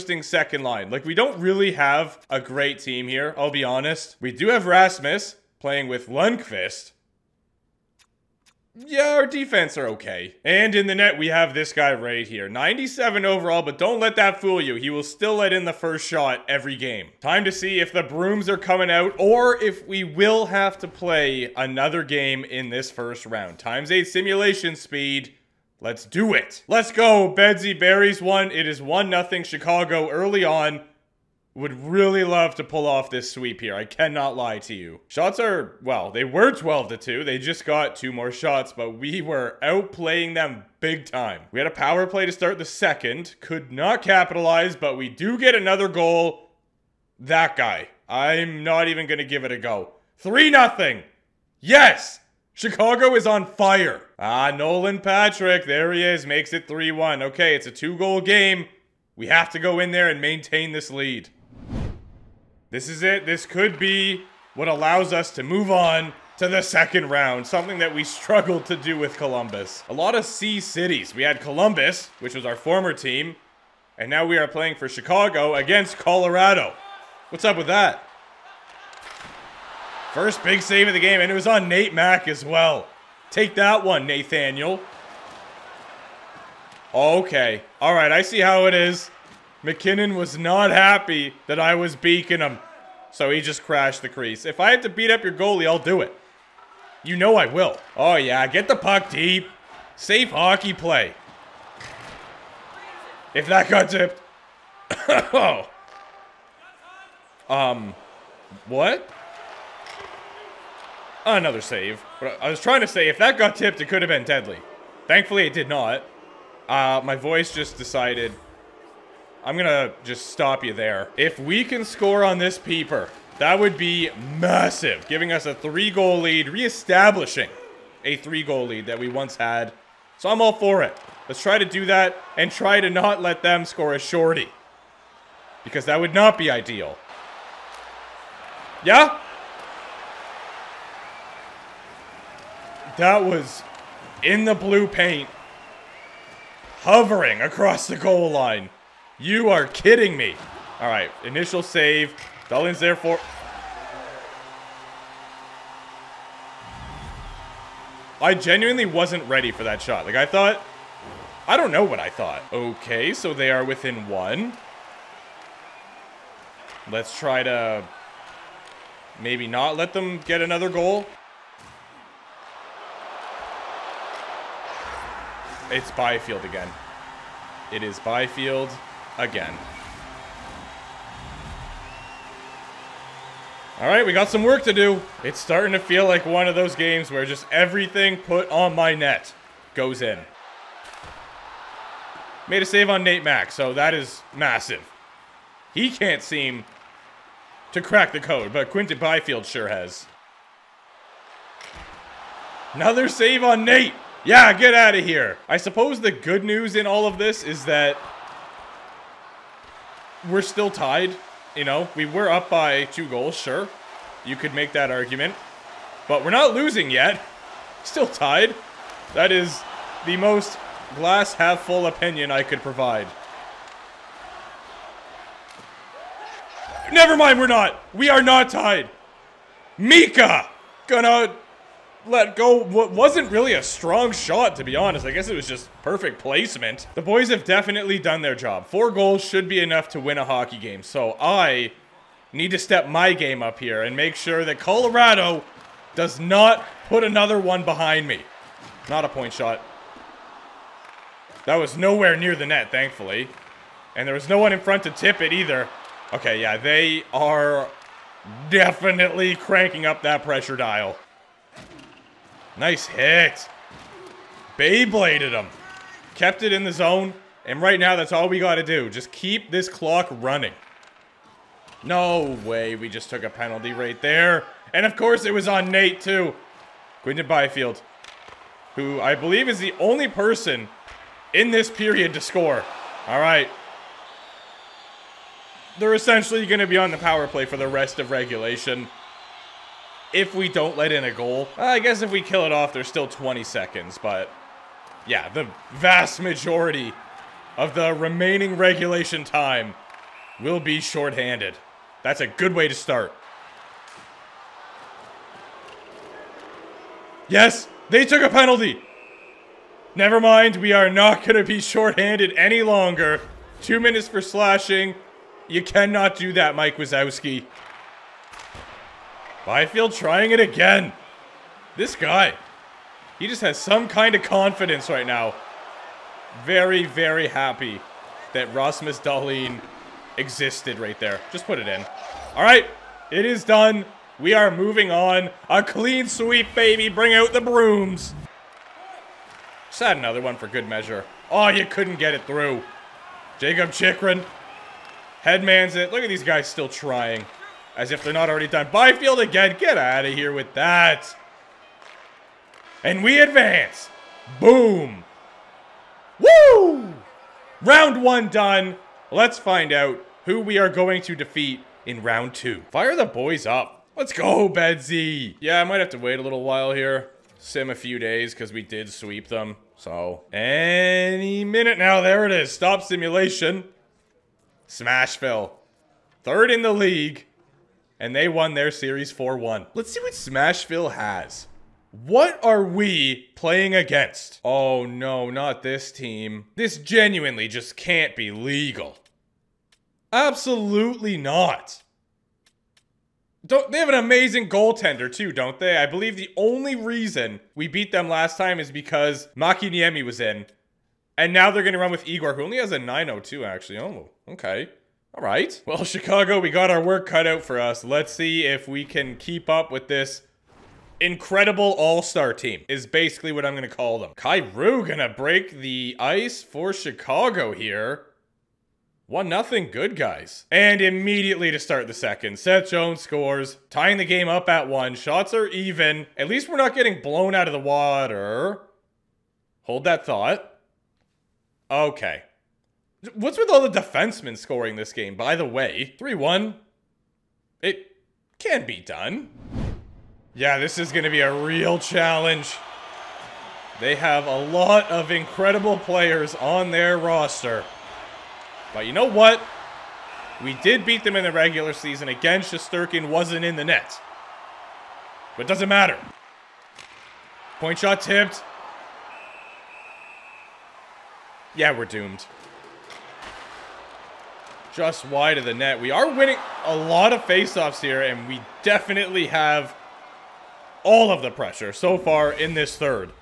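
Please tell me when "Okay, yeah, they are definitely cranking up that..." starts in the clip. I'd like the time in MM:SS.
04:16.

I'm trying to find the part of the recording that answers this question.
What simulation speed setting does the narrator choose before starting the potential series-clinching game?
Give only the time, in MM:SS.
00:23.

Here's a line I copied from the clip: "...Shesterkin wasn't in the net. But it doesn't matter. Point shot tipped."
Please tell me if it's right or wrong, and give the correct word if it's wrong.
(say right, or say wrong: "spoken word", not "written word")
right.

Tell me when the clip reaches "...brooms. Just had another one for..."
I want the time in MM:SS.
05:37.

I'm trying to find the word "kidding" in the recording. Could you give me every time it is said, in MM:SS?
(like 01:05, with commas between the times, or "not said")
02:29.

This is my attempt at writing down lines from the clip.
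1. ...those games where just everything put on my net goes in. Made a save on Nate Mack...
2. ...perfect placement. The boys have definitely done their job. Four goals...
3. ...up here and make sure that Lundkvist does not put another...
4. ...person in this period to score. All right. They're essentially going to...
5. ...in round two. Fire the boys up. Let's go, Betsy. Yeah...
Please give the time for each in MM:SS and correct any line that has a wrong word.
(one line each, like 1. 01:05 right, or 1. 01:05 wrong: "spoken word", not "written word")
1. 03:06 right
2. 03:55 right
3. 04:03 wrong: "Colorado", not "Lundkvist"
4. 04:40 right
5. 06:01 right.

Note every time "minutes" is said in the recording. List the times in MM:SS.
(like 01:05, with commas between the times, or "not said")
05:13, 06:11.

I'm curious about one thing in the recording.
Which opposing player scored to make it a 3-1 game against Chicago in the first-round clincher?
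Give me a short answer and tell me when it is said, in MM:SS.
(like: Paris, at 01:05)
Nolan Patrick, at 00:54.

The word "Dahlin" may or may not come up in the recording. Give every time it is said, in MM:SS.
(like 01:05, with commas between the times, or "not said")
02:32, 05:28.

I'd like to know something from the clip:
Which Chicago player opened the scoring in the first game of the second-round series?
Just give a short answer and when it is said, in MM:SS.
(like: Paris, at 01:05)
Kyrou, at 06:54.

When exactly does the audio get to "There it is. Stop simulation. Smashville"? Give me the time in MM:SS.
06:12.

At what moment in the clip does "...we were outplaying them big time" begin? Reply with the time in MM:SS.
00:38.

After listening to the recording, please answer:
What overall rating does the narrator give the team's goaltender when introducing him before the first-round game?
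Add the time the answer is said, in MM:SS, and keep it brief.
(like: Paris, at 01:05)
97, at 00:12.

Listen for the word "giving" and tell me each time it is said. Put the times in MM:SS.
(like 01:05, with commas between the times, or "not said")
02:05.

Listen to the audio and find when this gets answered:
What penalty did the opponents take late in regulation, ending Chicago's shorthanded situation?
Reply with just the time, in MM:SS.
05:14.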